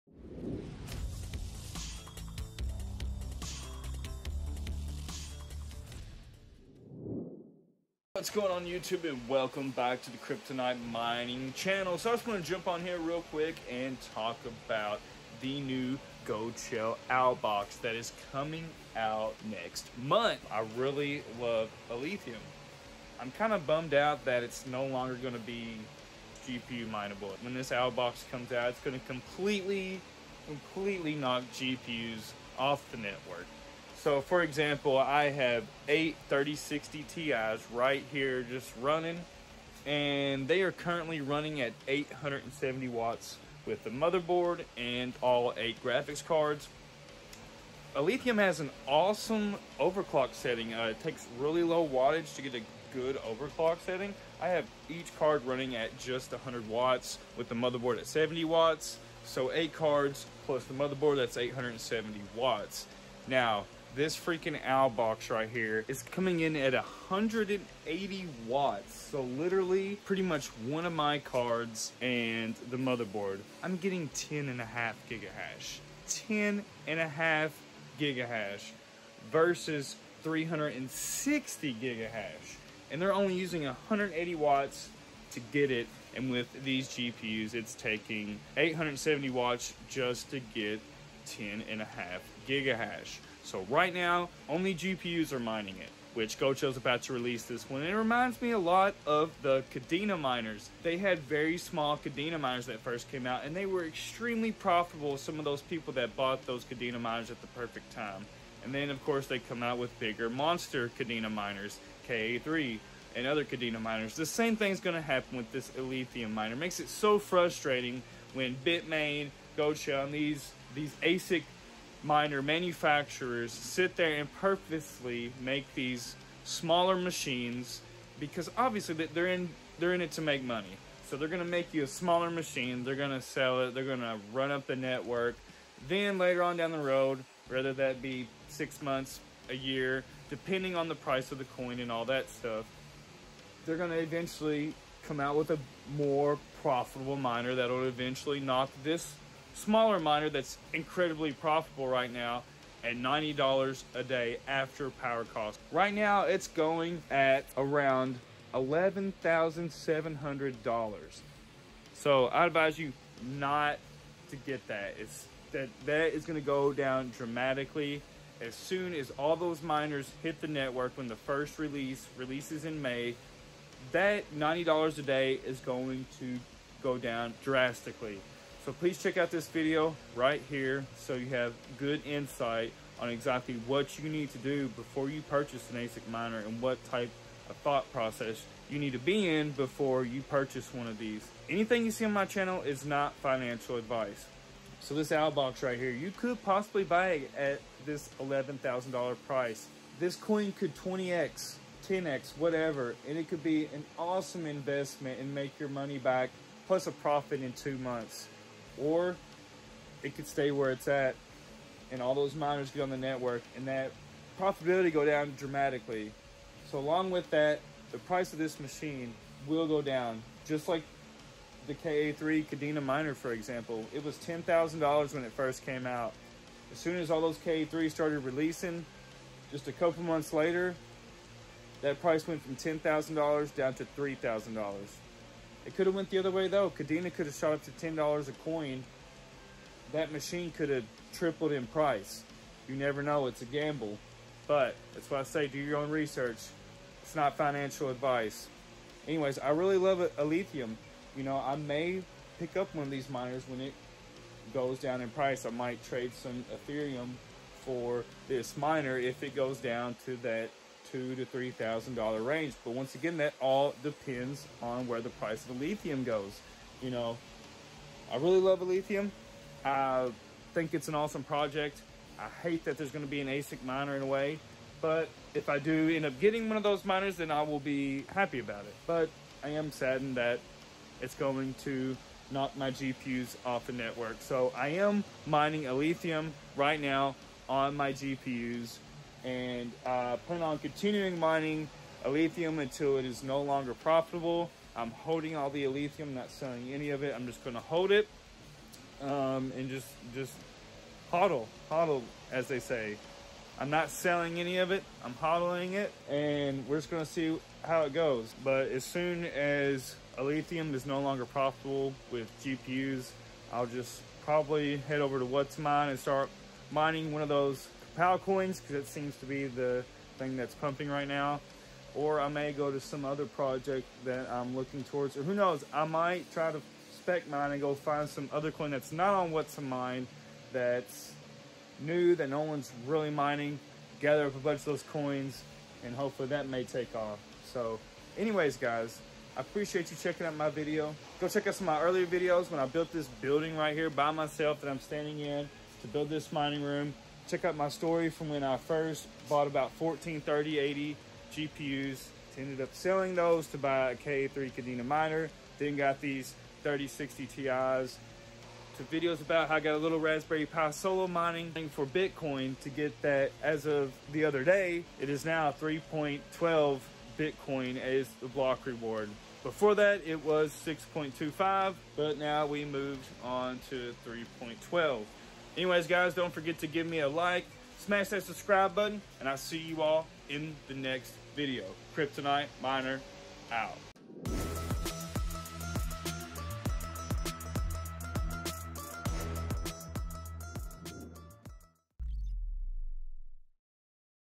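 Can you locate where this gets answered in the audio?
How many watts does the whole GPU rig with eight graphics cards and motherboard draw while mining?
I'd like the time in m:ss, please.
0:41.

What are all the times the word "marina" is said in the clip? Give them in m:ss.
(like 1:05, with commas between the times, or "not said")
not said.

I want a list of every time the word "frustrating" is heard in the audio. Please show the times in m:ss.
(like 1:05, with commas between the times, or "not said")
1:57.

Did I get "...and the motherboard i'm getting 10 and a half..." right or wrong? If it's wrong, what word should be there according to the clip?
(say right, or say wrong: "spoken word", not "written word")
right.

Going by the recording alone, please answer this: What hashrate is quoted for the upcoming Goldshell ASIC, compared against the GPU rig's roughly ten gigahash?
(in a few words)
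360 gigahash.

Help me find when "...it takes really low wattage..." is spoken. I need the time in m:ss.
0:50.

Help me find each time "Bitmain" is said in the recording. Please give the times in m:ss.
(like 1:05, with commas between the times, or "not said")
1:58.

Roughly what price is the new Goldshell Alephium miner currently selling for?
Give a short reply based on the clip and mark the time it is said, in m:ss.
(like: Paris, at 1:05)
$11,700, at 2:38.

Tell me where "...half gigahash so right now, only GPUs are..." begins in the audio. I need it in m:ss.
1:31.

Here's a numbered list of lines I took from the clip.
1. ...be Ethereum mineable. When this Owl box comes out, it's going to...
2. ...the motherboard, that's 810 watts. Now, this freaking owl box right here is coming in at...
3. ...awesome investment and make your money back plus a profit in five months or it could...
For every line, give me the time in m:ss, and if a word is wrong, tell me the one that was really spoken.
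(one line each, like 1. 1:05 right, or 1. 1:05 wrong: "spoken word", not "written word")
1. 0:25 wrong: "GPU", not "Ethereum"
2. 1:00 wrong: "870", not "810"
3. 3:23 wrong: "two", not "five".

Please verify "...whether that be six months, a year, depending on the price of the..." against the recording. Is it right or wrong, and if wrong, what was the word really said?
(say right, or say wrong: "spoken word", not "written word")
right.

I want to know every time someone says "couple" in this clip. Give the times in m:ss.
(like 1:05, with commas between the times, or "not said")
3:49.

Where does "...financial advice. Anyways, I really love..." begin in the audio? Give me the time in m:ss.
4:07.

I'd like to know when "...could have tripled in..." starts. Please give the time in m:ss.
4:00.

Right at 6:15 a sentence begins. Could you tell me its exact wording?
Anyways, guys, don't forget to give me a like, smash that subscribe button, and I'll see you all in the next video.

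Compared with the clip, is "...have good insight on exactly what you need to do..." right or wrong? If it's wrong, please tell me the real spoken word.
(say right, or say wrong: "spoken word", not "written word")
right.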